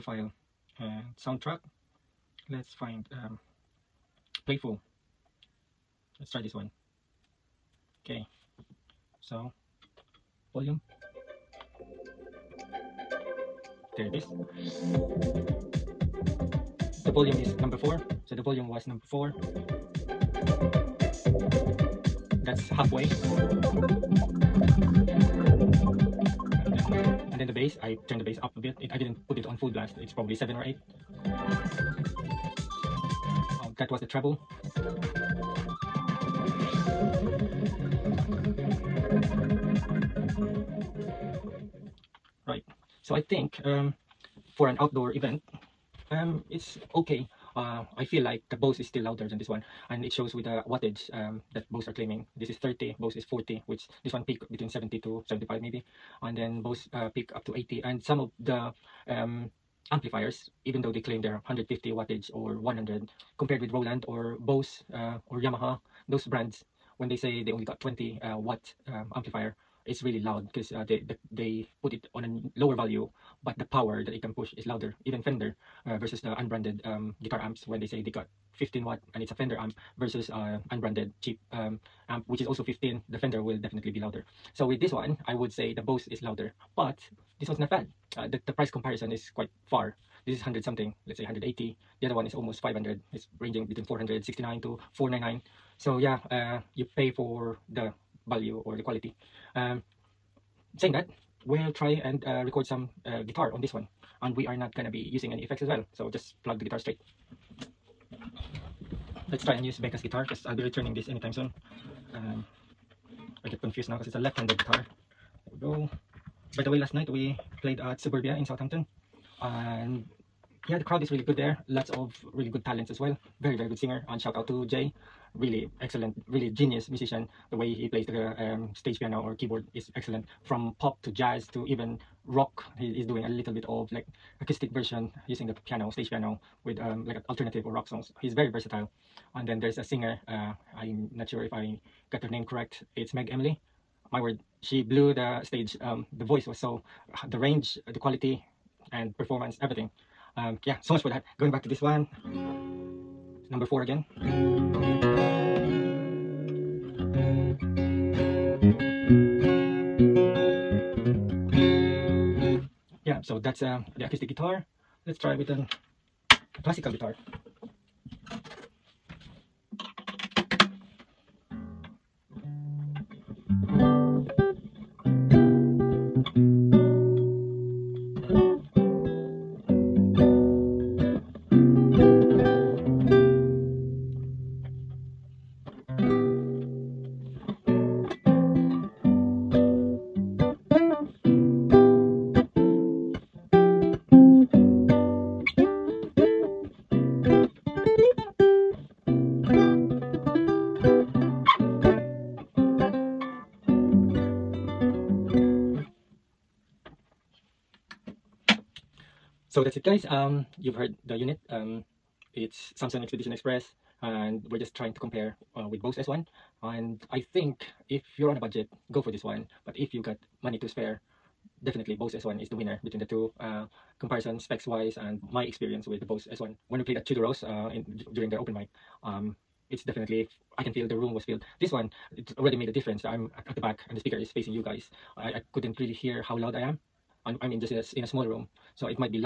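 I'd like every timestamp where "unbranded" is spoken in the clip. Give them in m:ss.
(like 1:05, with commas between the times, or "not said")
1:16, 1:20.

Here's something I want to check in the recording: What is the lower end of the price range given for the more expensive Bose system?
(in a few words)
469.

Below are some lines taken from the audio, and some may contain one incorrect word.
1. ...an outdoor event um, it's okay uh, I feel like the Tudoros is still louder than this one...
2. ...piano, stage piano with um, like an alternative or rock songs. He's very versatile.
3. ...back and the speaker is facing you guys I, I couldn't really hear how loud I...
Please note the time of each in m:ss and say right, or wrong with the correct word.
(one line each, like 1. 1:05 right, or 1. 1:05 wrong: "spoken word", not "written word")
1. 0:44 wrong: "Bose", not "Tudoros"
2. 2:15 right
3. 3:53 right.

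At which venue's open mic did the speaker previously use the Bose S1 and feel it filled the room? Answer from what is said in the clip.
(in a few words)
Tudoros.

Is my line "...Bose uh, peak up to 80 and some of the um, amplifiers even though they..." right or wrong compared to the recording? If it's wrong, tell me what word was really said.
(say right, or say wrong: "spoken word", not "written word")
right.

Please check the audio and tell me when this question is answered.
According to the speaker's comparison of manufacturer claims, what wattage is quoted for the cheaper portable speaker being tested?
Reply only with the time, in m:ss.
0:52.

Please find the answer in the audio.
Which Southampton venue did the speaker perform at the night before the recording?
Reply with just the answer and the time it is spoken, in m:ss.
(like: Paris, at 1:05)
Suburbia, at 1:57.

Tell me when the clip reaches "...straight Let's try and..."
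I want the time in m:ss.
1:46.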